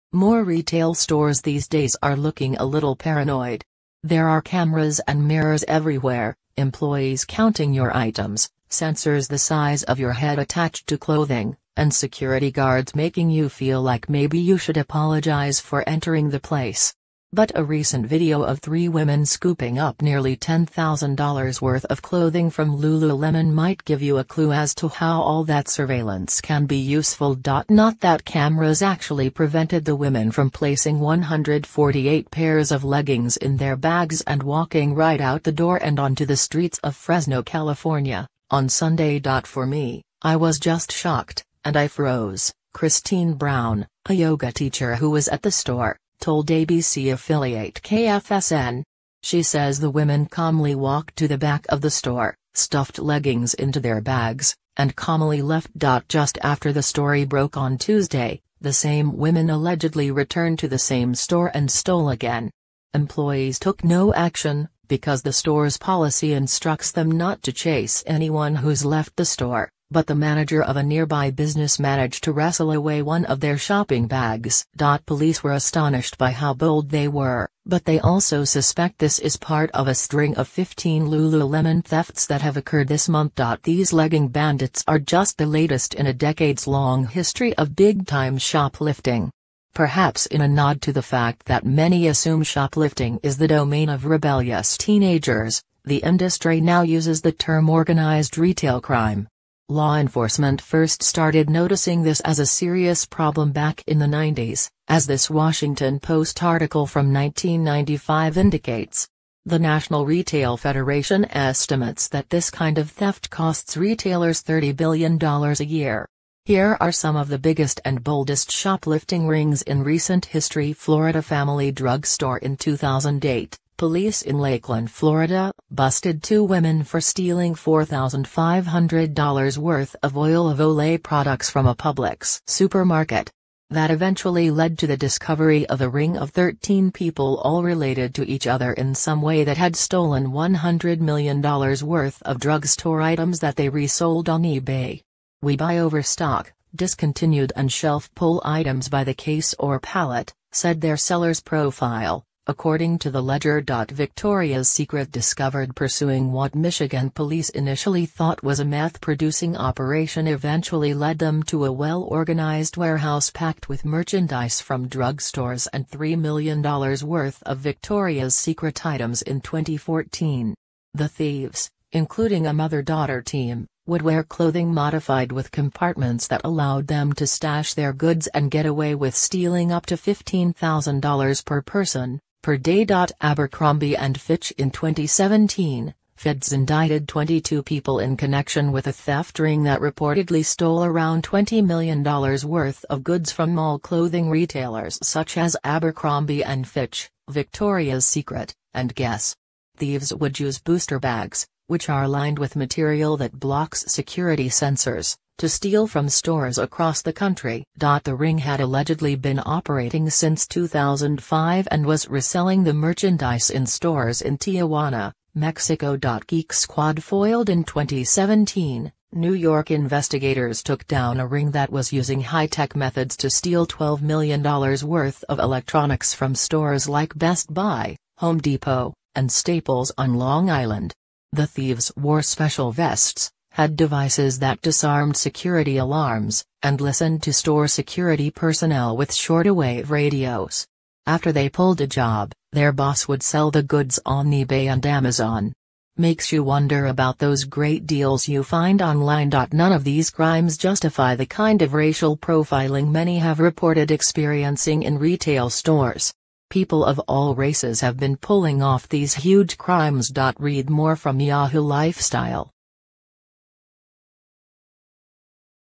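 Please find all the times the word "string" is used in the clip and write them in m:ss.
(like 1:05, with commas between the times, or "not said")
1:19.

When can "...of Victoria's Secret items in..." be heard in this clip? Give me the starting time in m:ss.
2:47.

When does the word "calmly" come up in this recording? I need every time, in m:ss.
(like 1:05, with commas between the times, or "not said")
0:50, 0:54.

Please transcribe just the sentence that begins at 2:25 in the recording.
We buy overstock, discontinued and shelf pull items by the case or pallet, said their seller's profile.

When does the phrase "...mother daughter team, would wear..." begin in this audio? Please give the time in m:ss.
2:52.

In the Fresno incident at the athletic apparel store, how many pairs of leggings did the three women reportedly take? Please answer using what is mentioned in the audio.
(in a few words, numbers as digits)
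148.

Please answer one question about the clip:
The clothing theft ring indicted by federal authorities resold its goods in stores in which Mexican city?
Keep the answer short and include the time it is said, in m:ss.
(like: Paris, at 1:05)
Tijuana, at 3:34.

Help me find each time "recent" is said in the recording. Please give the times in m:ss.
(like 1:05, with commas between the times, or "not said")
0:17, 1:59.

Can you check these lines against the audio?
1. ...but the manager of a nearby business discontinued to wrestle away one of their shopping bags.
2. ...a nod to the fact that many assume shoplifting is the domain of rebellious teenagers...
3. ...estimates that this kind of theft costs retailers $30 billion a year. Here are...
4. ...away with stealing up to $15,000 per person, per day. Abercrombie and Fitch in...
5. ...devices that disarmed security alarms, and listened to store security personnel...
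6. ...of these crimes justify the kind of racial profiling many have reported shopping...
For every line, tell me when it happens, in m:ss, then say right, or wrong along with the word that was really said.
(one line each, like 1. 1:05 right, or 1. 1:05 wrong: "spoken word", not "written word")
1. 1:09 wrong: "managed", not "discontinued"
2. 1:30 right
3. 1:51 right
4. 2:58 right
5. 3:53 right
6. 4:09 wrong: "experiencing", not "shopping".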